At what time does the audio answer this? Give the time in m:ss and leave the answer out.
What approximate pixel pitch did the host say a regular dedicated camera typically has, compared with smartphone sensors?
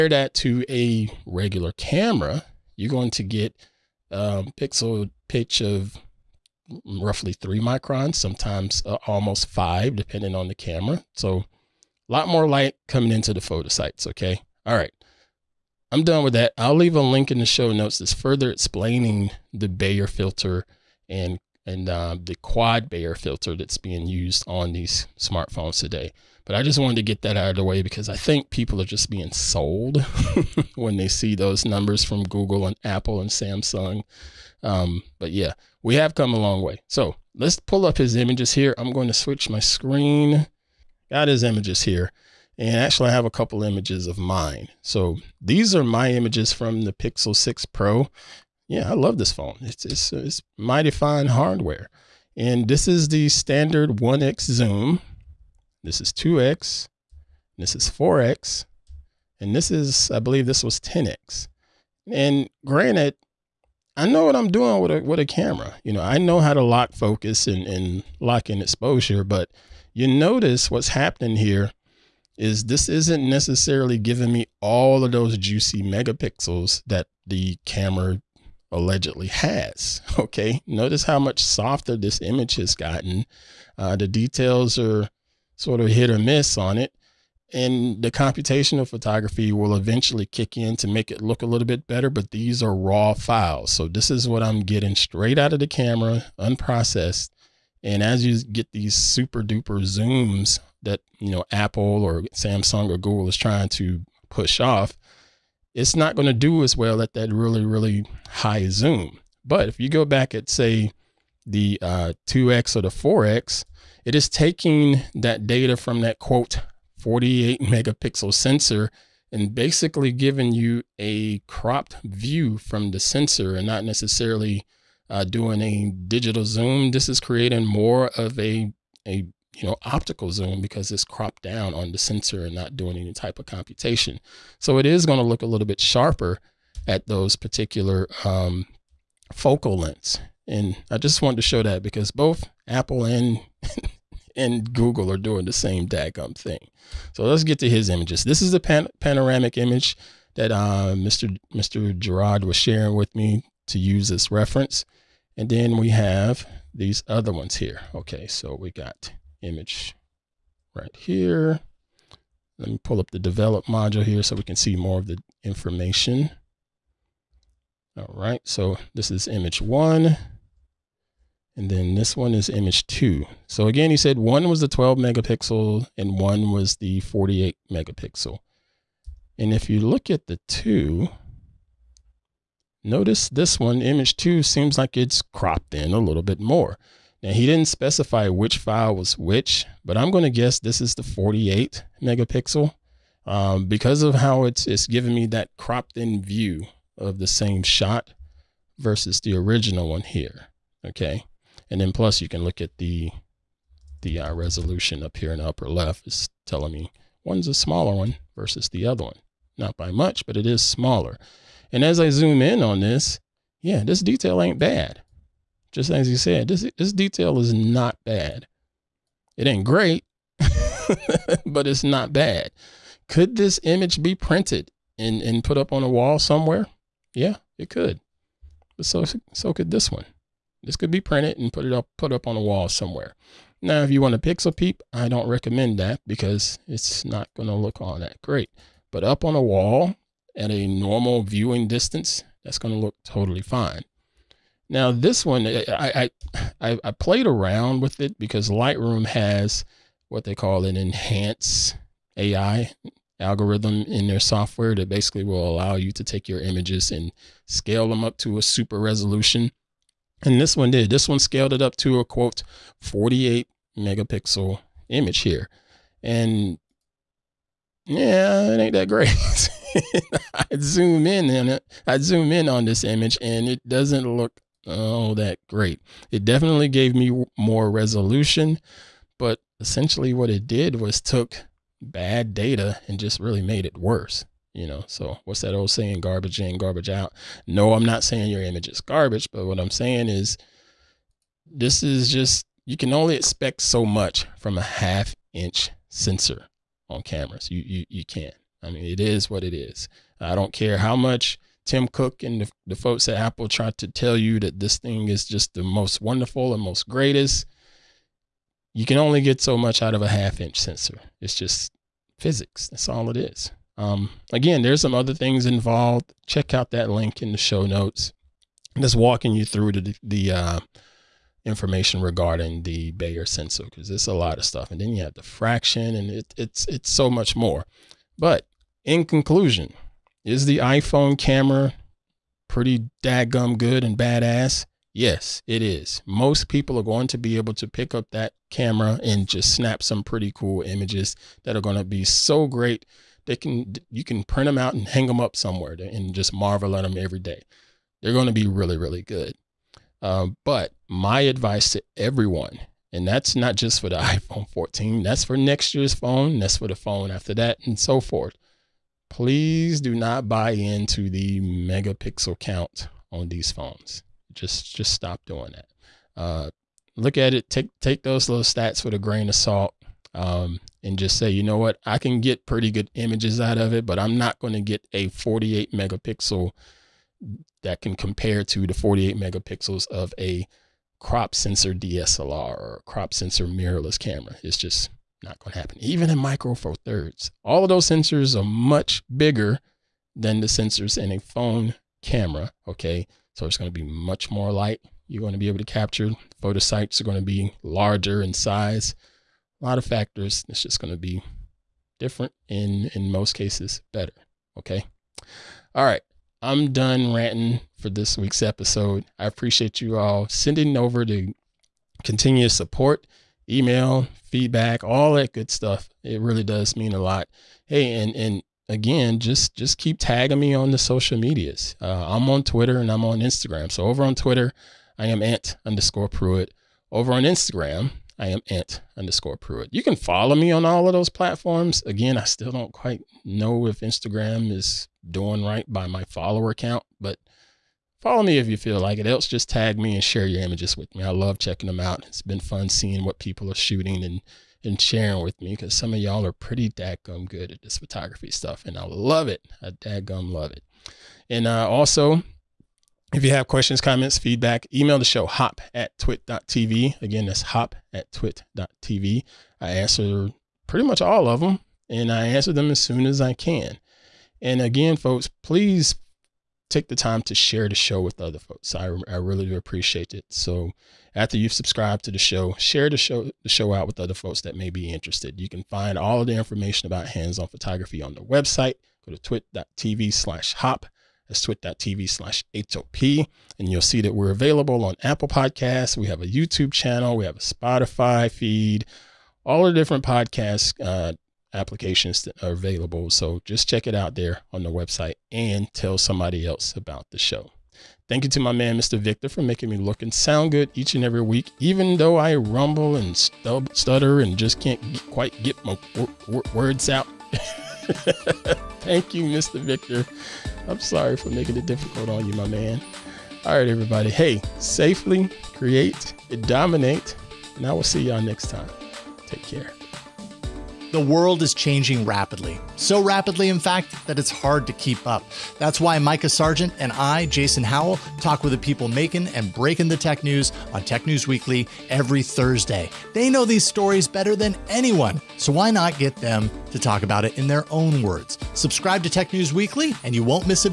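0:07.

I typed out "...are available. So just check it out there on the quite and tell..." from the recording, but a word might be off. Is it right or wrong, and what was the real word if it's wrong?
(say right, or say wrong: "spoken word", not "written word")
wrong: "website", not "quite".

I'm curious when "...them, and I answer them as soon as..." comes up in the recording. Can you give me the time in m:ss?
7:41.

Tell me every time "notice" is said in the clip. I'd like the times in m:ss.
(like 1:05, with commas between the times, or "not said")
1:10, 1:20, 3:02.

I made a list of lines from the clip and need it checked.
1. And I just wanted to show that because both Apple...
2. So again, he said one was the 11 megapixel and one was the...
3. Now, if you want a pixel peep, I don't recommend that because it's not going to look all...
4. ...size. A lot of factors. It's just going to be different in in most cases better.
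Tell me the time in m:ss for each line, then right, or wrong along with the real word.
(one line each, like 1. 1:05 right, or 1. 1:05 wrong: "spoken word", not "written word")
1. 2:20 right
2. 2:53 wrong: "12", not "11"
3. 3:53 right
4. 6:38 right.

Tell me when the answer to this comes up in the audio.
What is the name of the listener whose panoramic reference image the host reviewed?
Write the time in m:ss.
2:31.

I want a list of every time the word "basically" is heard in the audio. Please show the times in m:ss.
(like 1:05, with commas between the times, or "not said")
1:59, 4:14.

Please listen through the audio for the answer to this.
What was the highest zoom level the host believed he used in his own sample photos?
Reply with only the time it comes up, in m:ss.
1:00.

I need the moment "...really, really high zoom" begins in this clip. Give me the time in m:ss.
1:47.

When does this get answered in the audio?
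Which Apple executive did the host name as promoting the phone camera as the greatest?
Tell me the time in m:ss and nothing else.
5:01.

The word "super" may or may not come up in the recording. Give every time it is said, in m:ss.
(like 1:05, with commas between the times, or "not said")
1:38, 4:18.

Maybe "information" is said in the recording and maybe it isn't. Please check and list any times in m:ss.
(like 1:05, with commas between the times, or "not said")
2:45, 5:21, 7:56.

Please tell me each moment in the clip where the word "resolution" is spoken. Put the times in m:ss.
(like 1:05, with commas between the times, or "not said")
3:24, 4:18, 4:37.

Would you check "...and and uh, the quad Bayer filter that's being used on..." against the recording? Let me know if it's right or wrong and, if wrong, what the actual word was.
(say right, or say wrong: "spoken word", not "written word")
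right.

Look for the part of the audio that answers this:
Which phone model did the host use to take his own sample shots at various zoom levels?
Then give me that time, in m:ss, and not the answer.
0:46.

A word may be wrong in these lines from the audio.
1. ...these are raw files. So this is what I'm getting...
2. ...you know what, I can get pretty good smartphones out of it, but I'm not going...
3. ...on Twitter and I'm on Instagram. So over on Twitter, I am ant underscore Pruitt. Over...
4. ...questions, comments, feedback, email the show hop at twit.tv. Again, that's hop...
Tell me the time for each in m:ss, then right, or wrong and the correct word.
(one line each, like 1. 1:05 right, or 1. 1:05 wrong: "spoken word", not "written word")
1. 1:32 right
2. 6:11 wrong: "images", not "smartphones"
3. 7:02 right
4. 7:33 right.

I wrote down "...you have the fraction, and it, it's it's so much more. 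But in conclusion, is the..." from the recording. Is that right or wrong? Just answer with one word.
right.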